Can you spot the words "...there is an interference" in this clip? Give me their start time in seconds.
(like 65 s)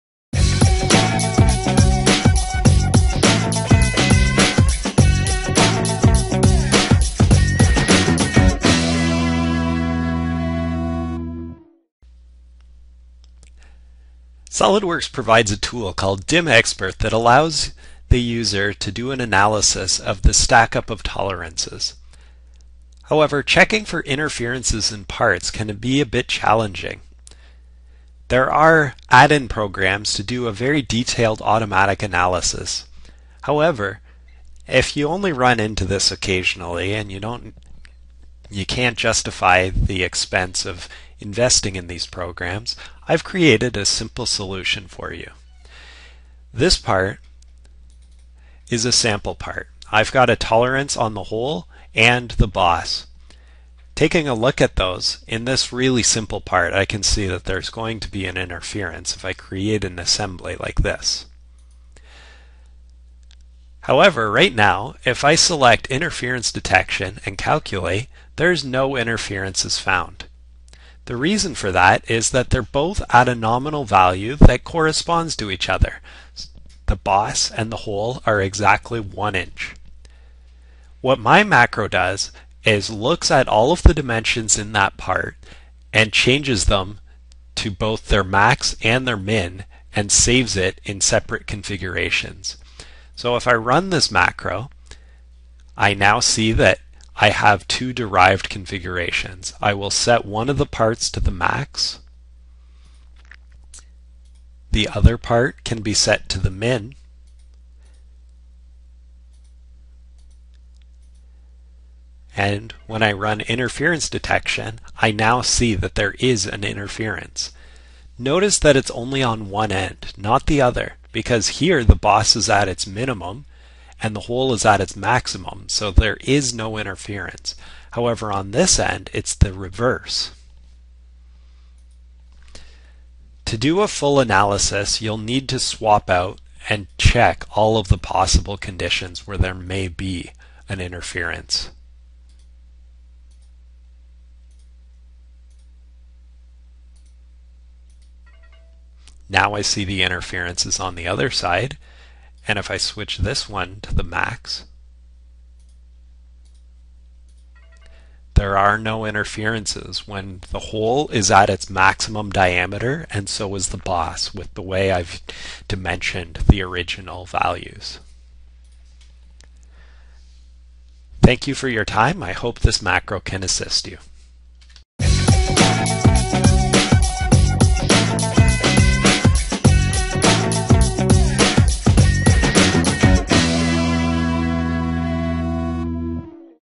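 115 s.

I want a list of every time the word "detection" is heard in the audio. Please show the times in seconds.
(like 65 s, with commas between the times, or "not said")
66 s, 114 s.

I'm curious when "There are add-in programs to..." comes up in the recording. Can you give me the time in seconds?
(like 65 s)
28 s.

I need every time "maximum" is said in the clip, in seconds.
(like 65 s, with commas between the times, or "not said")
124 s, 161 s.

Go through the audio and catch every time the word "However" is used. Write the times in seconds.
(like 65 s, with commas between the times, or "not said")
23 s, 33 s, 63 s, 127 s.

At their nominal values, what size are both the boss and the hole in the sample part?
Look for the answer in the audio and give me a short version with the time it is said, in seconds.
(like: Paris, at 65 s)
1 inch, at 78 s.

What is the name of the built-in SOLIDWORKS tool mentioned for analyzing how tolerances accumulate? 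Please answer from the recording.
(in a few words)
DimExpert.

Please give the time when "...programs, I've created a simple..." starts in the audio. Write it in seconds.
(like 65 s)
42 s.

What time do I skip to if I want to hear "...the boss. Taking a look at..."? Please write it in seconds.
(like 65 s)
52 s.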